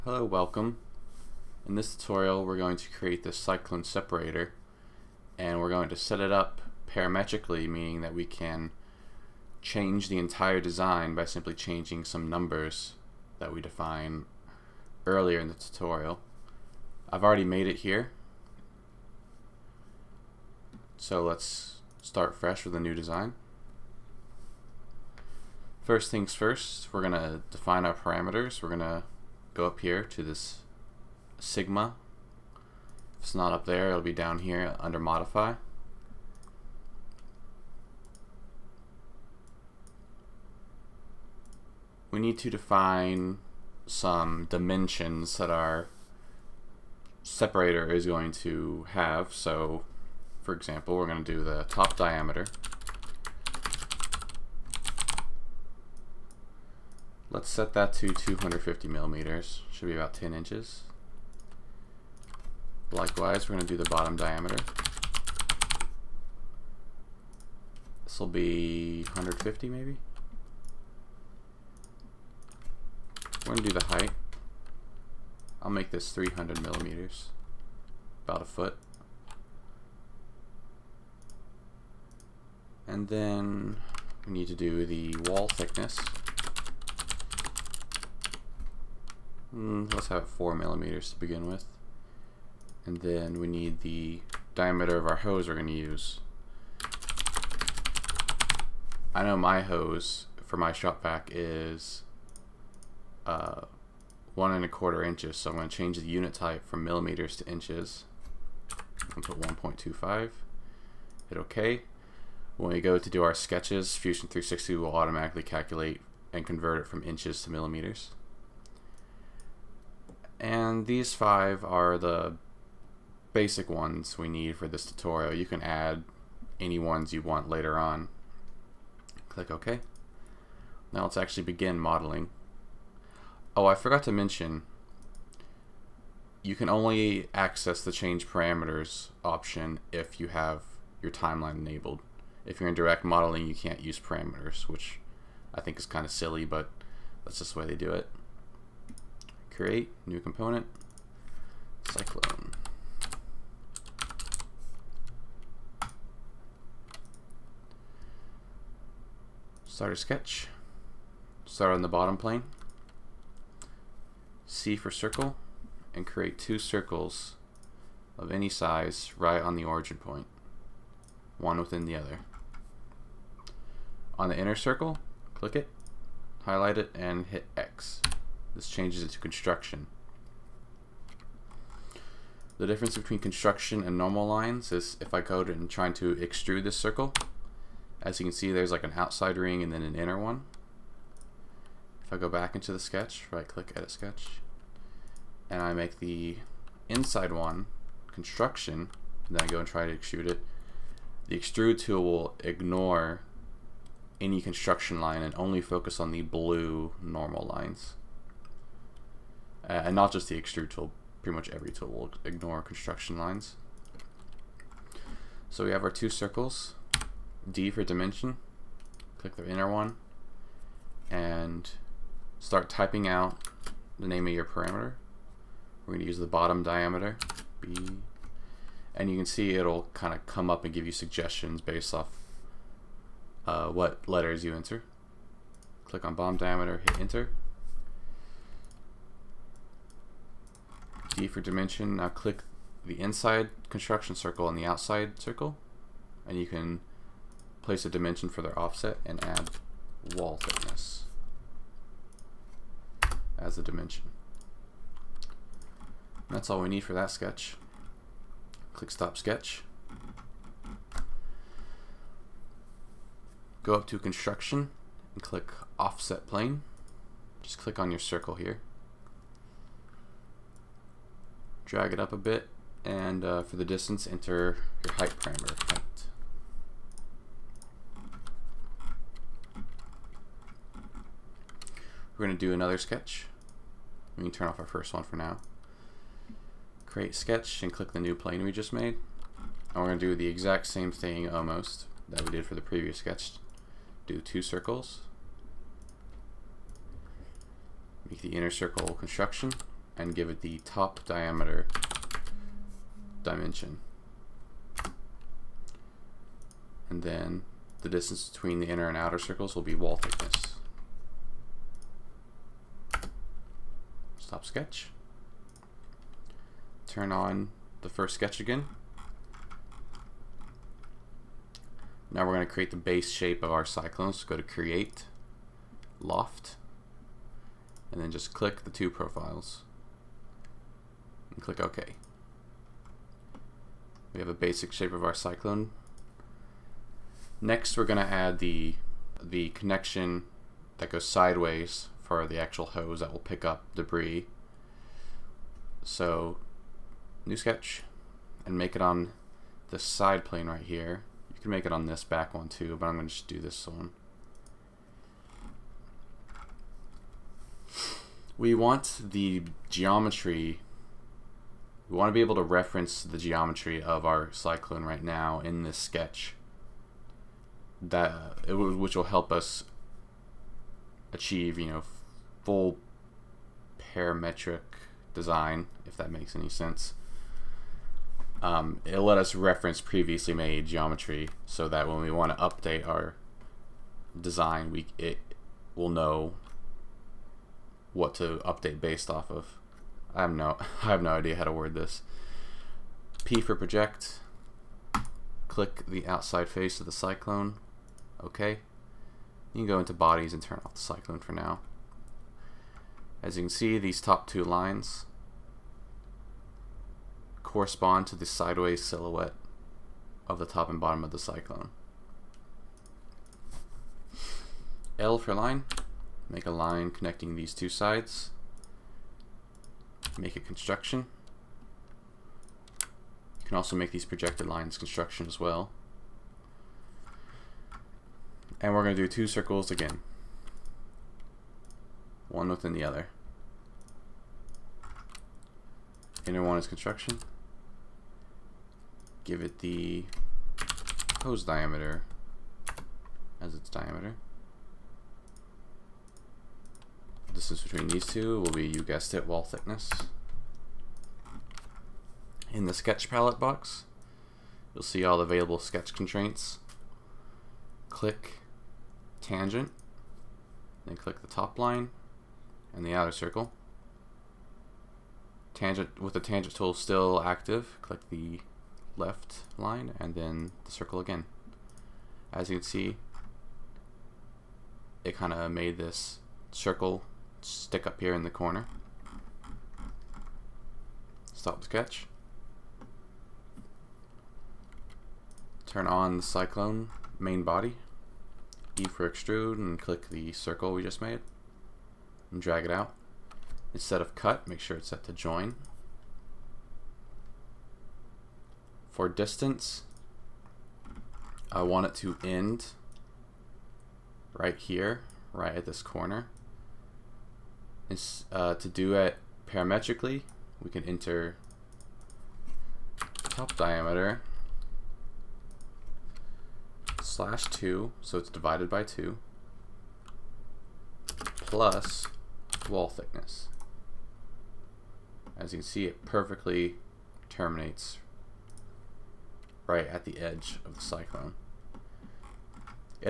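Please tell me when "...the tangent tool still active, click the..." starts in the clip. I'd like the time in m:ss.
7:46.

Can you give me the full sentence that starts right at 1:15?
I'll make this 300 millimeters, about a foot.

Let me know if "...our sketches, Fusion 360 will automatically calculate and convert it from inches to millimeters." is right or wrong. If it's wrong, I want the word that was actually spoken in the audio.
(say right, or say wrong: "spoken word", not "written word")
right.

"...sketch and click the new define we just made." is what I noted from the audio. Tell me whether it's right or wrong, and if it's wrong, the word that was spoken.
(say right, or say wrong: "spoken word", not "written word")
wrong: "plane", not "define".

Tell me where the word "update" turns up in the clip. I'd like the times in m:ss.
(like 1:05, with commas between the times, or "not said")
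6:22, 6:28.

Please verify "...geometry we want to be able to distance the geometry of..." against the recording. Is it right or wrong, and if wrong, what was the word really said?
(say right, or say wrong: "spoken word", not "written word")
wrong: "reference", not "distance".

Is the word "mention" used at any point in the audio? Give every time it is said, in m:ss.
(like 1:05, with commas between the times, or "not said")
2:14.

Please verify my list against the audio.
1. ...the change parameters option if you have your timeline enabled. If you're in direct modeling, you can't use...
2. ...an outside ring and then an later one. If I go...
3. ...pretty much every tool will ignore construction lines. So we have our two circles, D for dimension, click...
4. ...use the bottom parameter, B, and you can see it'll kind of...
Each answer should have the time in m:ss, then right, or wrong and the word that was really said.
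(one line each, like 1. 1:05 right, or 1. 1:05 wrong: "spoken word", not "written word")
1. 2:17 right
2. 3:08 wrong: "inner", not "later"
3. 3:31 right
4. 3:46 wrong: "diameter", not "parameter".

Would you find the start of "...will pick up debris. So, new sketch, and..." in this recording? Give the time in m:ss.
5:43.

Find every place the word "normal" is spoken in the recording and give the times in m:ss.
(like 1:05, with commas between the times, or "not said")
3:03, 3:27.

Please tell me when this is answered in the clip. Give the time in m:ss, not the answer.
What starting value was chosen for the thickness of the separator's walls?
1:30.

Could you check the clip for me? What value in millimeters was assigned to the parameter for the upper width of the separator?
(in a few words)
250 millimeters.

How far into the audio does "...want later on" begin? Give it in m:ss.
2:07.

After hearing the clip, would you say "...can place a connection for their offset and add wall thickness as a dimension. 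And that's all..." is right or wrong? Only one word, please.
wrong.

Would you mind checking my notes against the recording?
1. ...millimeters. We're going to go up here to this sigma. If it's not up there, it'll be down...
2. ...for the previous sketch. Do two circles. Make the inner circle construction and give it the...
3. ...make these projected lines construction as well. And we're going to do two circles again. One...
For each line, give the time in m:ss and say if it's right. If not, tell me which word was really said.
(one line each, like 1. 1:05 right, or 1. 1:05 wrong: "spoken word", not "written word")
1. 0:27 wrong: "parameters", not "millimeters"
2. 4:52 right
3. 7:03 right.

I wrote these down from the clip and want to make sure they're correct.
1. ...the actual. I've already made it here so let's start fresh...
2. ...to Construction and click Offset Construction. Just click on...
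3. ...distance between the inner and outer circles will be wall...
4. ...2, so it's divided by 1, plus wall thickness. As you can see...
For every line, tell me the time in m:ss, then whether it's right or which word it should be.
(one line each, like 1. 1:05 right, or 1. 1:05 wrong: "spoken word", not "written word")
1. 0:15 wrong: "tutorial", not "actual"
2. 4:23 wrong: "Plane", not "Construction"
3. 5:07 right
4. 8:37 wrong: "2", not "1".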